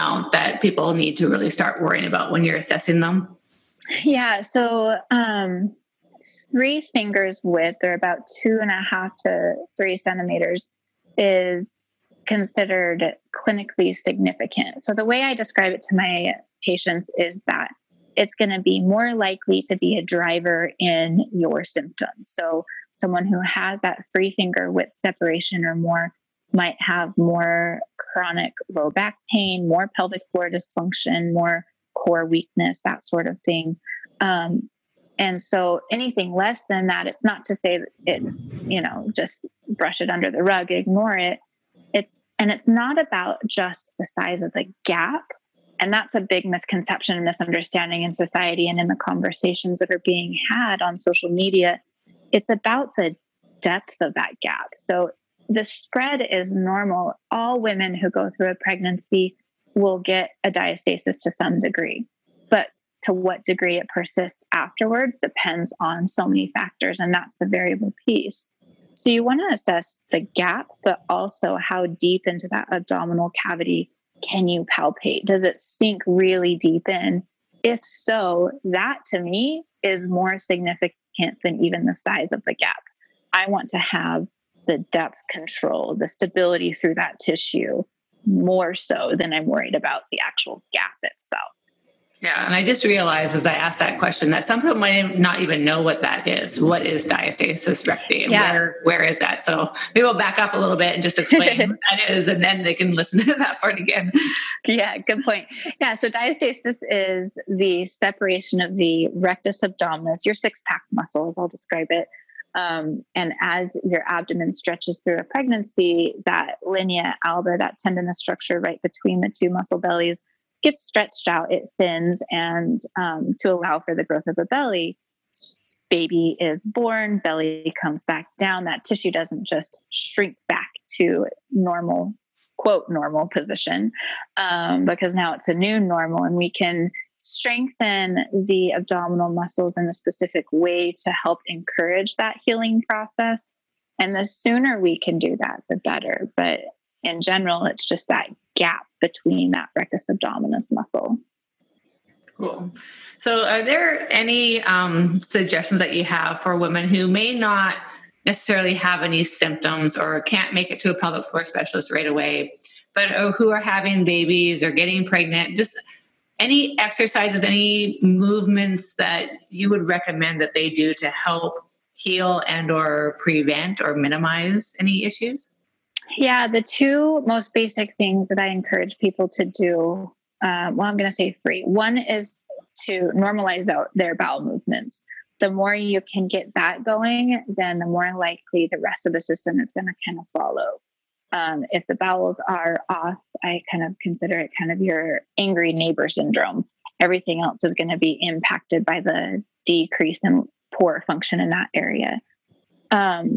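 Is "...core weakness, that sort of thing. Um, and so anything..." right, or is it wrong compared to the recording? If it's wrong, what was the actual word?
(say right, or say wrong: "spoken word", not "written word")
right.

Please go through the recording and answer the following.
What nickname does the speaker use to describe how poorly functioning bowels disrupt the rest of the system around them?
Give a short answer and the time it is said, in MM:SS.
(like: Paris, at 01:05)
angry neighbor syndrome, at 03:15.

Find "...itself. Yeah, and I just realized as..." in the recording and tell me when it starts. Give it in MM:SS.
01:31.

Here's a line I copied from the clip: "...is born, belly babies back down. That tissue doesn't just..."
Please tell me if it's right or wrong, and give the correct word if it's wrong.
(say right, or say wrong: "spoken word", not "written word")
wrong: "comes", not "babies".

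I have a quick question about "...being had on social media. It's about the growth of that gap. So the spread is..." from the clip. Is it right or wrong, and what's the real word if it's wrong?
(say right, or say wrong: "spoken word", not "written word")
wrong: "depth", not "growth".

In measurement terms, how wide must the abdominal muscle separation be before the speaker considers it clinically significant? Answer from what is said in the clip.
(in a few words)
2.5 to 3 cm.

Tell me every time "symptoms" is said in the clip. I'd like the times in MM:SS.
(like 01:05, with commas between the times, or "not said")
00:21, 02:39.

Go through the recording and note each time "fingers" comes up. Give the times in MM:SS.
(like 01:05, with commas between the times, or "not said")
00:06, 00:24.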